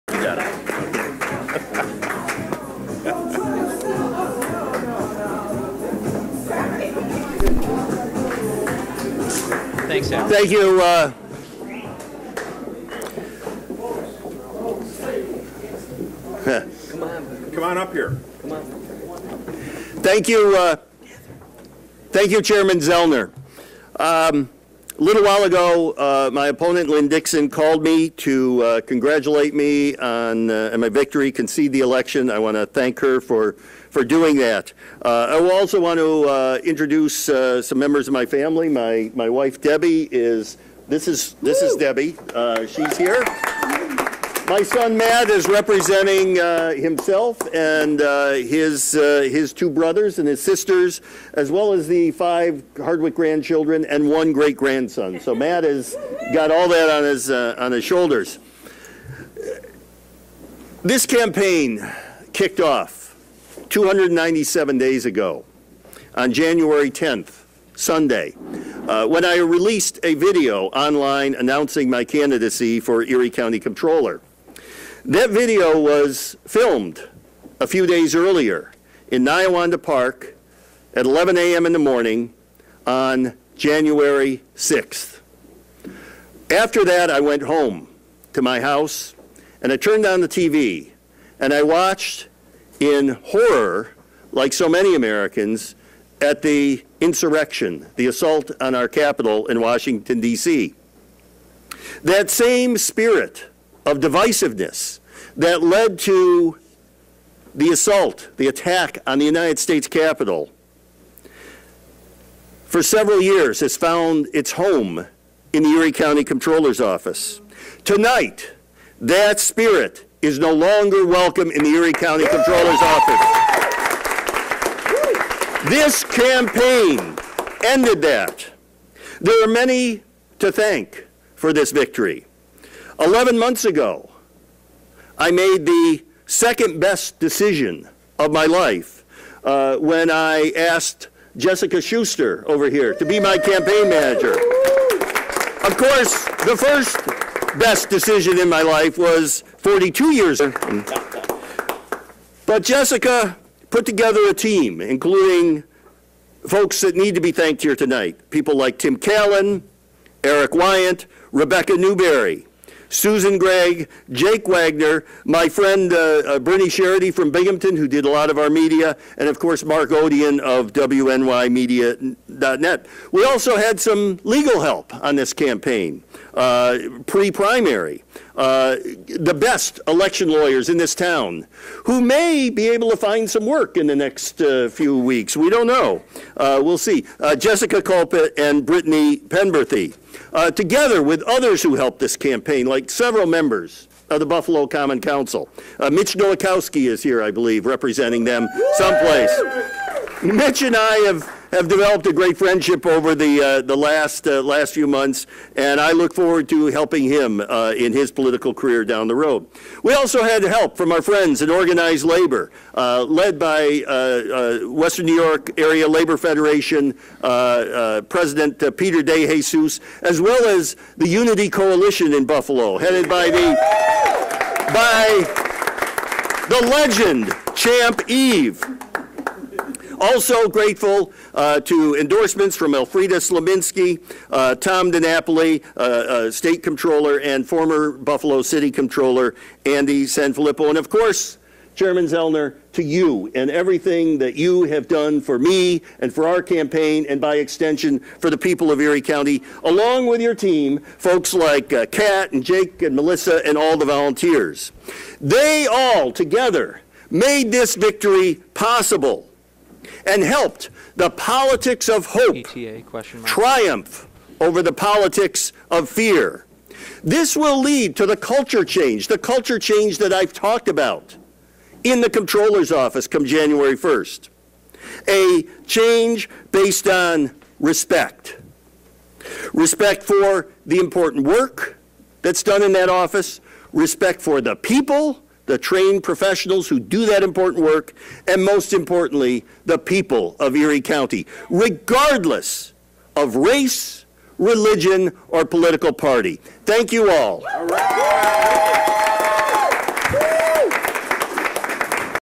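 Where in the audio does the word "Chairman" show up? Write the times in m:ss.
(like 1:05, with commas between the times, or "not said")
0:22, 4:01.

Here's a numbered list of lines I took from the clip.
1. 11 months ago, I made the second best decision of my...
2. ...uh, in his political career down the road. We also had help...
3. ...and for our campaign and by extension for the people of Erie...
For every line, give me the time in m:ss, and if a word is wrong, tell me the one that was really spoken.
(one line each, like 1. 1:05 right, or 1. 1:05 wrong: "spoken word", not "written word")
1. 2:13 right
2. 3:27 right
3. 4:05 right.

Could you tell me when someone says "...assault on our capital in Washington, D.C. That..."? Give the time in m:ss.
1:38.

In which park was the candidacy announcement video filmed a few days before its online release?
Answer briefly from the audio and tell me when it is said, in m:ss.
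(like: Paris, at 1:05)
Niawanda Park, at 1:19.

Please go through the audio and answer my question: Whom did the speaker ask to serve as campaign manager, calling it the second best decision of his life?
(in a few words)
Jessica Schuster.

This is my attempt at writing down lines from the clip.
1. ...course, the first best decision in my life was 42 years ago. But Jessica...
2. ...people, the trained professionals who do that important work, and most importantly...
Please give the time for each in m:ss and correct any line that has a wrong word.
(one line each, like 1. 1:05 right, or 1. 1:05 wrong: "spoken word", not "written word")
1. 2:25 right
2. 4:44 right.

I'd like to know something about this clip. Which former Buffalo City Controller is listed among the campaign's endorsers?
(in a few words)
Andy SanFilippo.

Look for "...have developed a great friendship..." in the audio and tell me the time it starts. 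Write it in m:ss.
3:21.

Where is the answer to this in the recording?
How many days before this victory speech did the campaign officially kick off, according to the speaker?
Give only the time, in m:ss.
1:03.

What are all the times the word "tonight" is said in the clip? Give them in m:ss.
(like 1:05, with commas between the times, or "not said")
1:57, 2:37.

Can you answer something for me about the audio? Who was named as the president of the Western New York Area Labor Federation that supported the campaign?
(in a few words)
Peter De Jesus.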